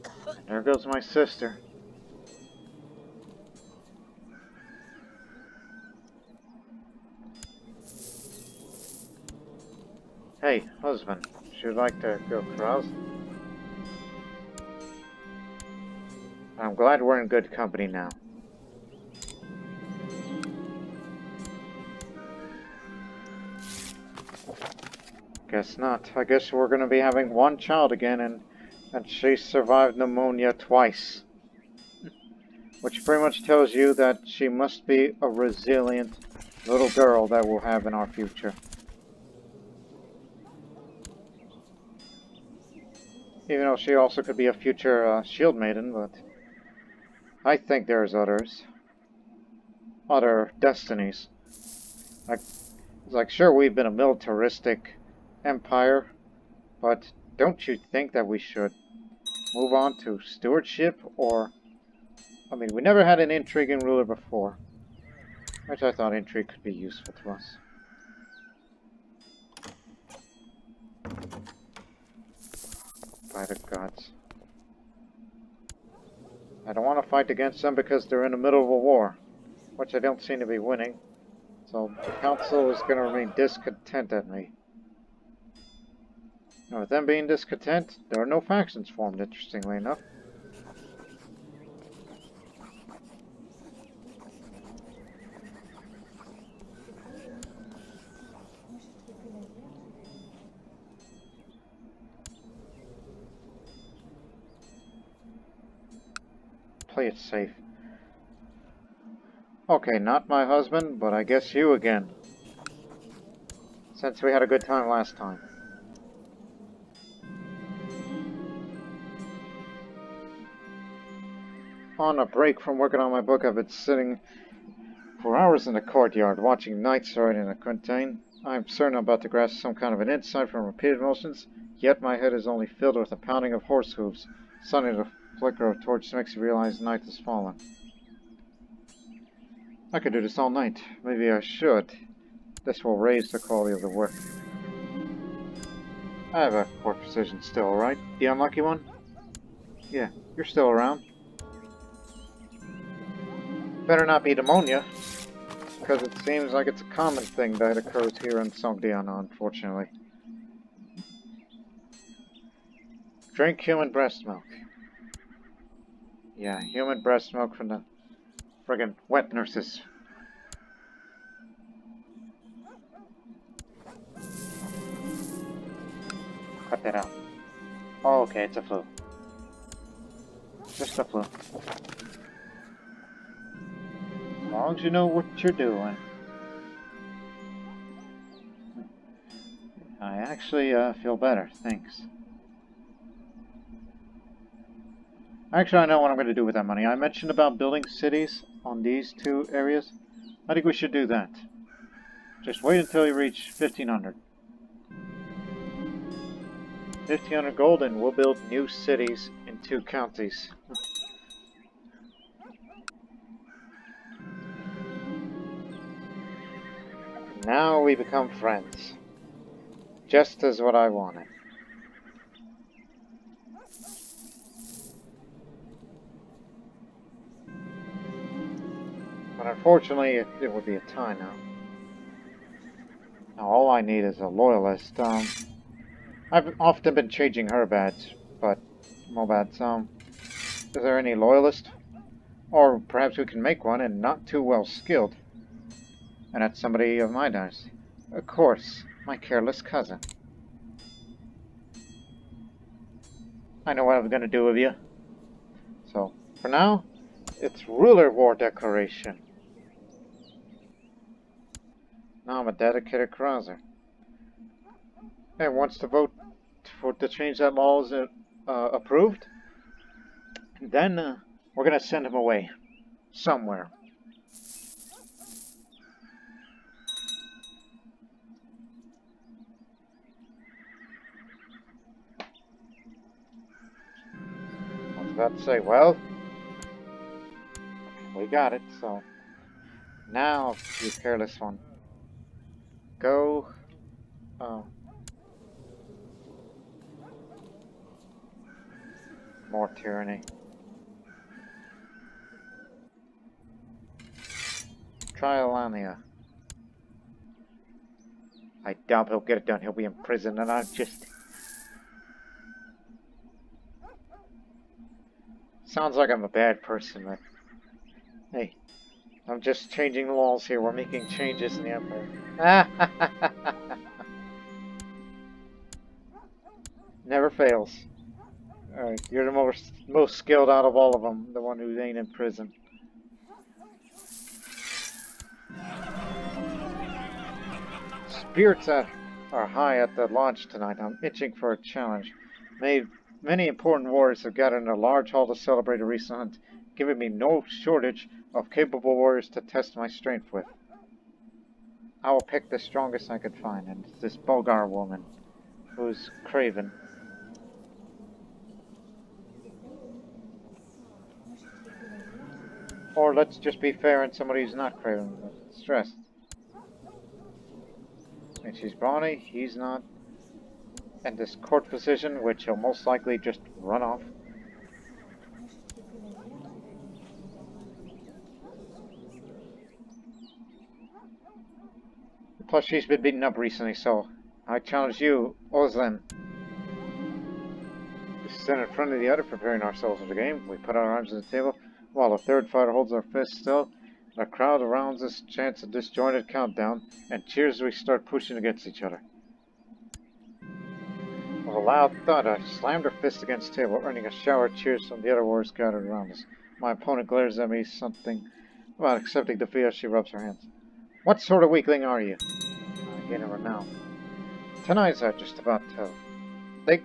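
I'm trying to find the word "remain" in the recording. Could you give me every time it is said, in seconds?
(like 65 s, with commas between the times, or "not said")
83 s.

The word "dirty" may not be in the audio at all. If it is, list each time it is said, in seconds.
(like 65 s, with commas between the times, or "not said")
not said.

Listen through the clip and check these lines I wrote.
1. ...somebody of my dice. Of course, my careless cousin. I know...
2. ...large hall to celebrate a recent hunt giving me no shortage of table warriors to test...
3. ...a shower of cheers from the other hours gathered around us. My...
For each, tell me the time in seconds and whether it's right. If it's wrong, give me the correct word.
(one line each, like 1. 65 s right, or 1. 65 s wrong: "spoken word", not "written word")
1. 246 s right
2. 344 s wrong: "capable", not "table"
3. 404 s wrong: "warriors", not "hours".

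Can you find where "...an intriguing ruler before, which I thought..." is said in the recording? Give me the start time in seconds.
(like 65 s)
63 s.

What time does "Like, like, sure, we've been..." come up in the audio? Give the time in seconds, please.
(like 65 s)
52 s.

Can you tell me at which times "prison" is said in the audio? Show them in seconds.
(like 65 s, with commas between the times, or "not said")
310 s, 332 s.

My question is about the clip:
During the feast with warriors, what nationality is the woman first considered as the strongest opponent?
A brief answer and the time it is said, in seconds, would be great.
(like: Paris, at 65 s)
Bulgar, at 354 s.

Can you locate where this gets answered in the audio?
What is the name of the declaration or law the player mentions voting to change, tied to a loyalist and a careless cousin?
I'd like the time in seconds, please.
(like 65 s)
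257 s.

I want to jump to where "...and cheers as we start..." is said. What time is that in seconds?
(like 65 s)
397 s.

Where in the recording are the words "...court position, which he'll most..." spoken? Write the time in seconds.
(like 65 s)
371 s.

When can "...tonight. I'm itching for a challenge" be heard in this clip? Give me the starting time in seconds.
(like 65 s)
340 s.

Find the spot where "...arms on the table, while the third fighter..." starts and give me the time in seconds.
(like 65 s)
390 s.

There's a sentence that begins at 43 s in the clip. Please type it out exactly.
Even though she also could be a future uh, shield maiden, but I think there's others.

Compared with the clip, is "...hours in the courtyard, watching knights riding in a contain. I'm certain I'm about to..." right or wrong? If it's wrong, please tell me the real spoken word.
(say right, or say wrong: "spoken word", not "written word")
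right.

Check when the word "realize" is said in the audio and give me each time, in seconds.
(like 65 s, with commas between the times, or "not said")
136 s.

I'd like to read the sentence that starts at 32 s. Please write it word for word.
Which pretty much tells you that she must be a resilient little girl that we'll have in our future.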